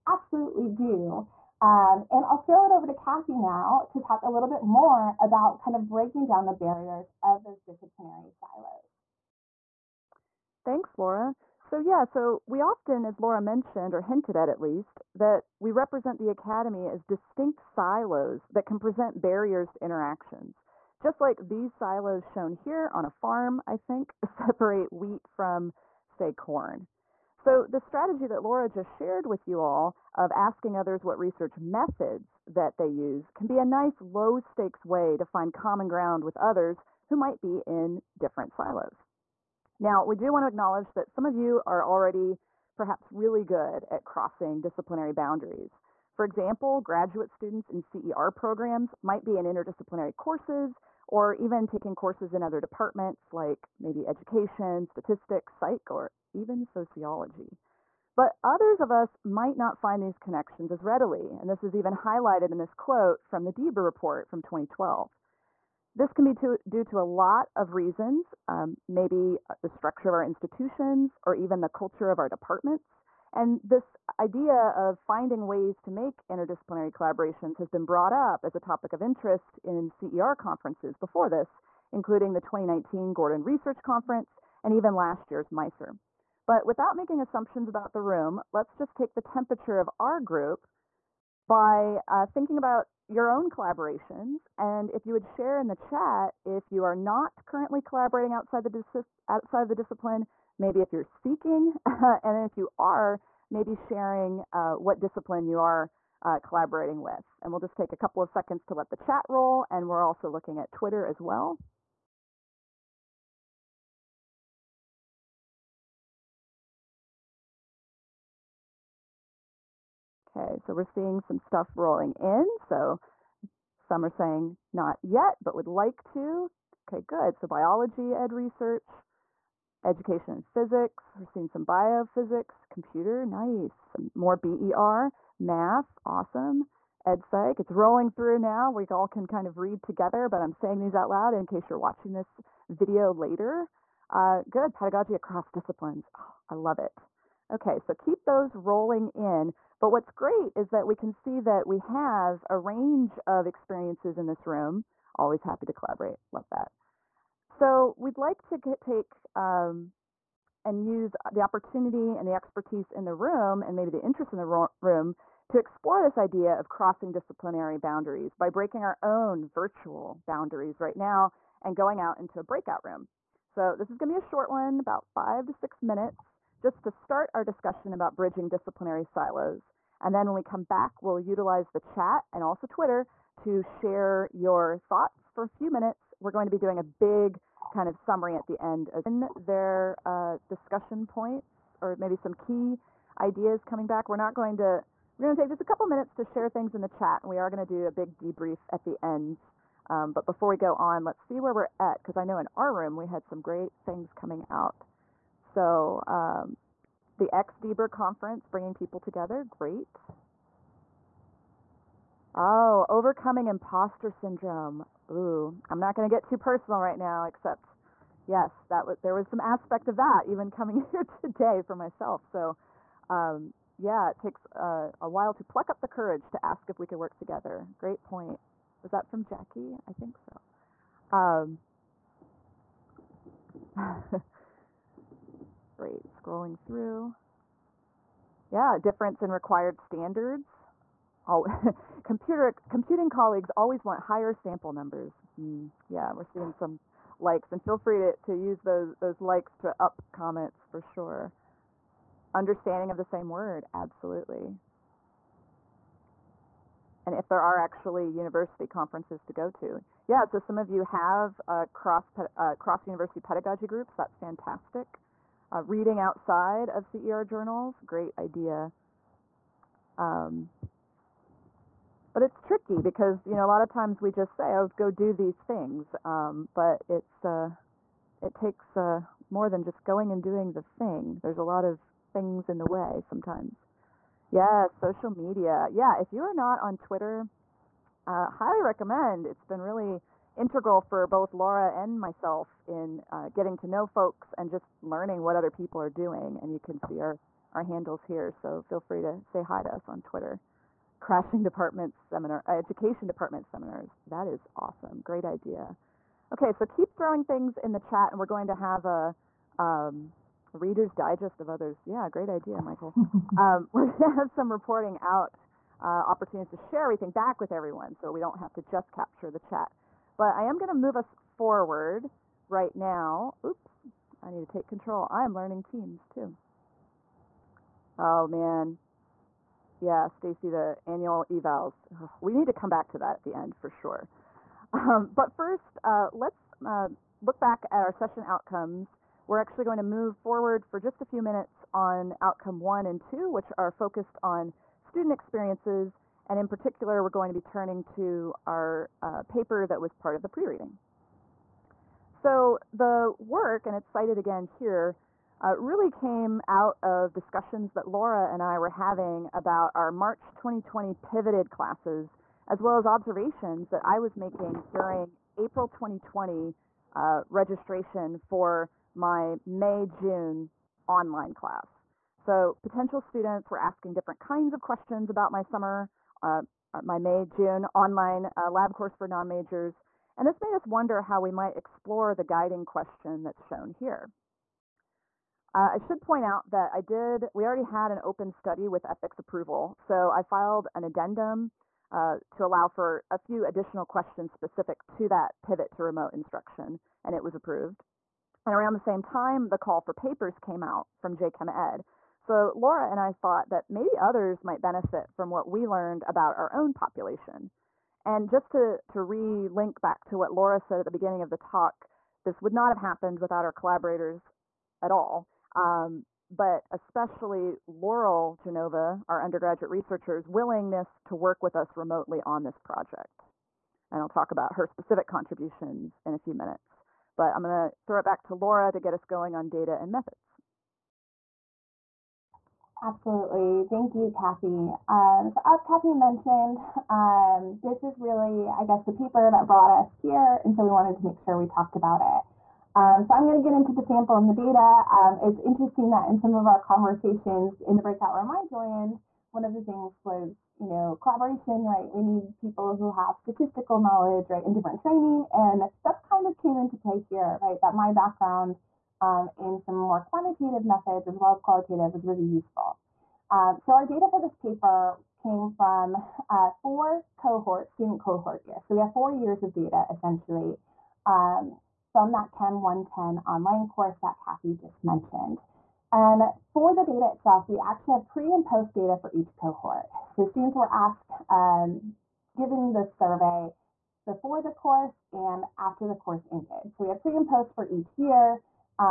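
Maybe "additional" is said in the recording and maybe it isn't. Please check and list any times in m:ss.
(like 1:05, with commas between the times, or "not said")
6:33.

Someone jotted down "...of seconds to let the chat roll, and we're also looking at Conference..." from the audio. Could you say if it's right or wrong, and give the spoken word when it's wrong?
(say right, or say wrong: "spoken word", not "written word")
wrong: "Twitter", not "Conference".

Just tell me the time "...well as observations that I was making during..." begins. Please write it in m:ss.
6:02.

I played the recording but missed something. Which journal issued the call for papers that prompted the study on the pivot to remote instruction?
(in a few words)
JChem Ed.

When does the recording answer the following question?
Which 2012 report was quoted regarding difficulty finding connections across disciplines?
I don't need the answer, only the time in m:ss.
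1:03.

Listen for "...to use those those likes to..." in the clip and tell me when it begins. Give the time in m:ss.
4:08.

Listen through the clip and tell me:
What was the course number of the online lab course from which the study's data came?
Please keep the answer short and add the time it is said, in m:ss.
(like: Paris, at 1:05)
Chem 110, at 7:52.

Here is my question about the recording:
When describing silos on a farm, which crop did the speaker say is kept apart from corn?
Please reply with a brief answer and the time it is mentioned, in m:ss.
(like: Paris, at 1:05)
wheat, at 0:24.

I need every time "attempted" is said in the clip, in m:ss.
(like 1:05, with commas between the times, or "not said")
not said.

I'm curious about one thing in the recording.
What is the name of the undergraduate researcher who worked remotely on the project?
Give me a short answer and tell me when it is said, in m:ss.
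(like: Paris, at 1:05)
Laurel Genova, at 6:57.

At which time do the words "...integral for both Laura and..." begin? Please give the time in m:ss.
4:50.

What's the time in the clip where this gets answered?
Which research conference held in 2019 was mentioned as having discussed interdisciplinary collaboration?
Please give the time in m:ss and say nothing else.
1:23.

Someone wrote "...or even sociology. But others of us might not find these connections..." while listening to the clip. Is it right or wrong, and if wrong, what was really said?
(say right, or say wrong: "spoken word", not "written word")
right.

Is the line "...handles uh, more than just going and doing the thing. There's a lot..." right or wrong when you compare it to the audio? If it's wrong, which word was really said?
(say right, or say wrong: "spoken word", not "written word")
wrong: "takes", not "handles".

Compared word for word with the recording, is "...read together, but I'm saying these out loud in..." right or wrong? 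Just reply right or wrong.
right.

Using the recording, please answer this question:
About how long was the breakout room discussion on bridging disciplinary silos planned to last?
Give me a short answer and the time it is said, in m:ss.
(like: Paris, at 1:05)
5 to 6 minutes, at 2:55.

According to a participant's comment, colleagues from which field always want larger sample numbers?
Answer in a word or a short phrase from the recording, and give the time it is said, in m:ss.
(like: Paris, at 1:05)
computing, at 4:02.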